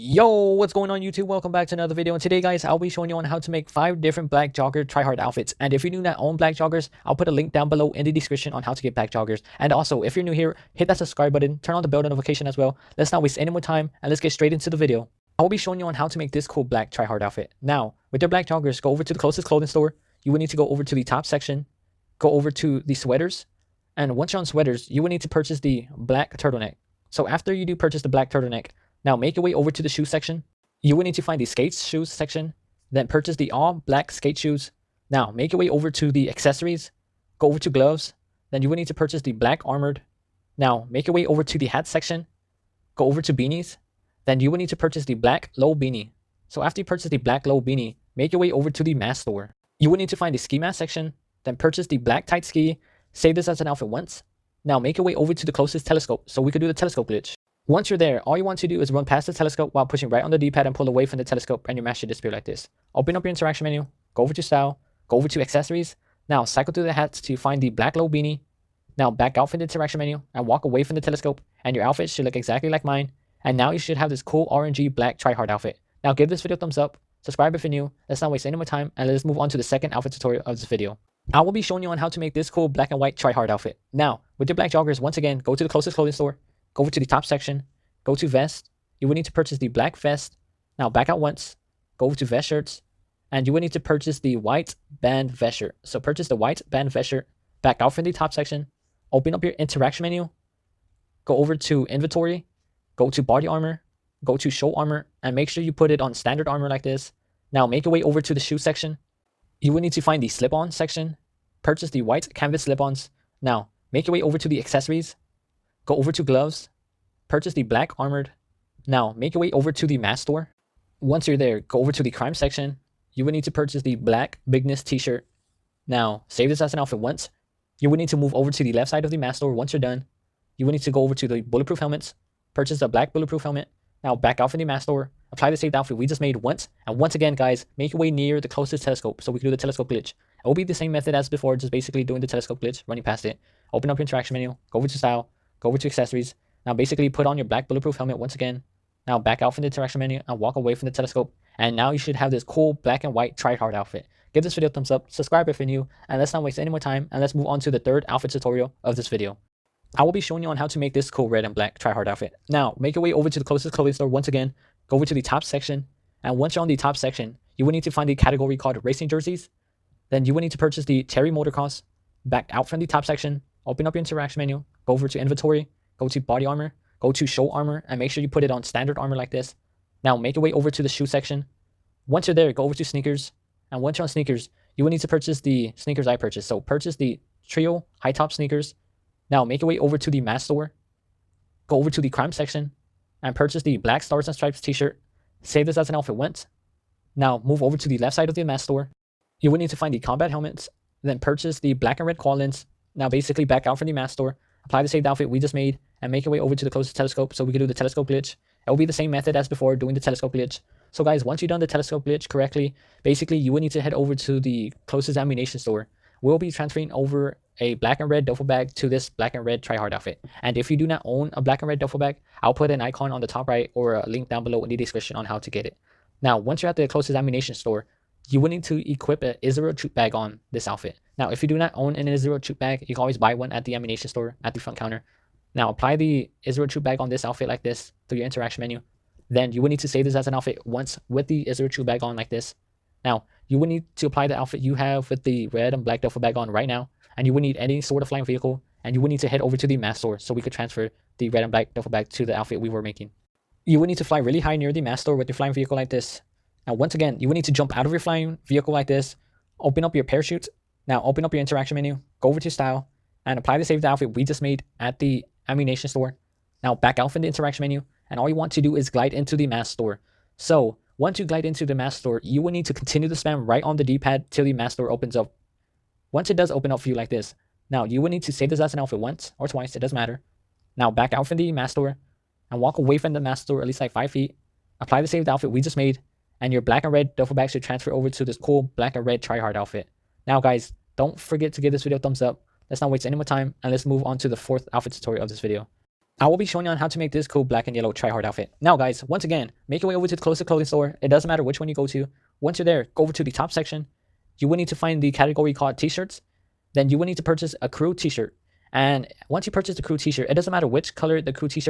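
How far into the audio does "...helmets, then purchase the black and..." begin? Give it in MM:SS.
03:20.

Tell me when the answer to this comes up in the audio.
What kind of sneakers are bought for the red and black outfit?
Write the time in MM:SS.
03:07.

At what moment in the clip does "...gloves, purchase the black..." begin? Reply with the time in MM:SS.
01:56.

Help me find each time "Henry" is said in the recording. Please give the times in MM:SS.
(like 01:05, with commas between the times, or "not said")
not said.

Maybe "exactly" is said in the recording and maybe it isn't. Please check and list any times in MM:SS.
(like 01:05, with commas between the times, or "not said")
01:12.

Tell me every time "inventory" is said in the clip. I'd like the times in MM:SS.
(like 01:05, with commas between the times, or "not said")
01:41, 02:55.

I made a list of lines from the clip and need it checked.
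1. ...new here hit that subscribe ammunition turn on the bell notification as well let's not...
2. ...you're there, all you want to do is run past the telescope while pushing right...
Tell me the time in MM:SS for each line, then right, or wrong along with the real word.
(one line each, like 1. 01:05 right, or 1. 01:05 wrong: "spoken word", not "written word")
1. 00:10 wrong: "button", not "ammunition"
2. 00:57 right.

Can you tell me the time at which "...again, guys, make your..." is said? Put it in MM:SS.
02:17.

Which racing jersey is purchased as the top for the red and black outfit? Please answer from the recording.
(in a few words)
Terry Motor Cause.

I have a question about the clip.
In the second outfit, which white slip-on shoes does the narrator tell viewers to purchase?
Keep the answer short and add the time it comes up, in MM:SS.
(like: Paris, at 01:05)
white canvas slip-ons, at 01:52.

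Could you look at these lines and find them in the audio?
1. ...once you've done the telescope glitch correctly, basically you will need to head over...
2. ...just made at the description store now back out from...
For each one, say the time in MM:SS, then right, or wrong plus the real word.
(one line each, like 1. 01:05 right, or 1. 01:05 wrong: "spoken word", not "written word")
1. 03:31 right
2. 04:24 wrong: "ammunition", not "description".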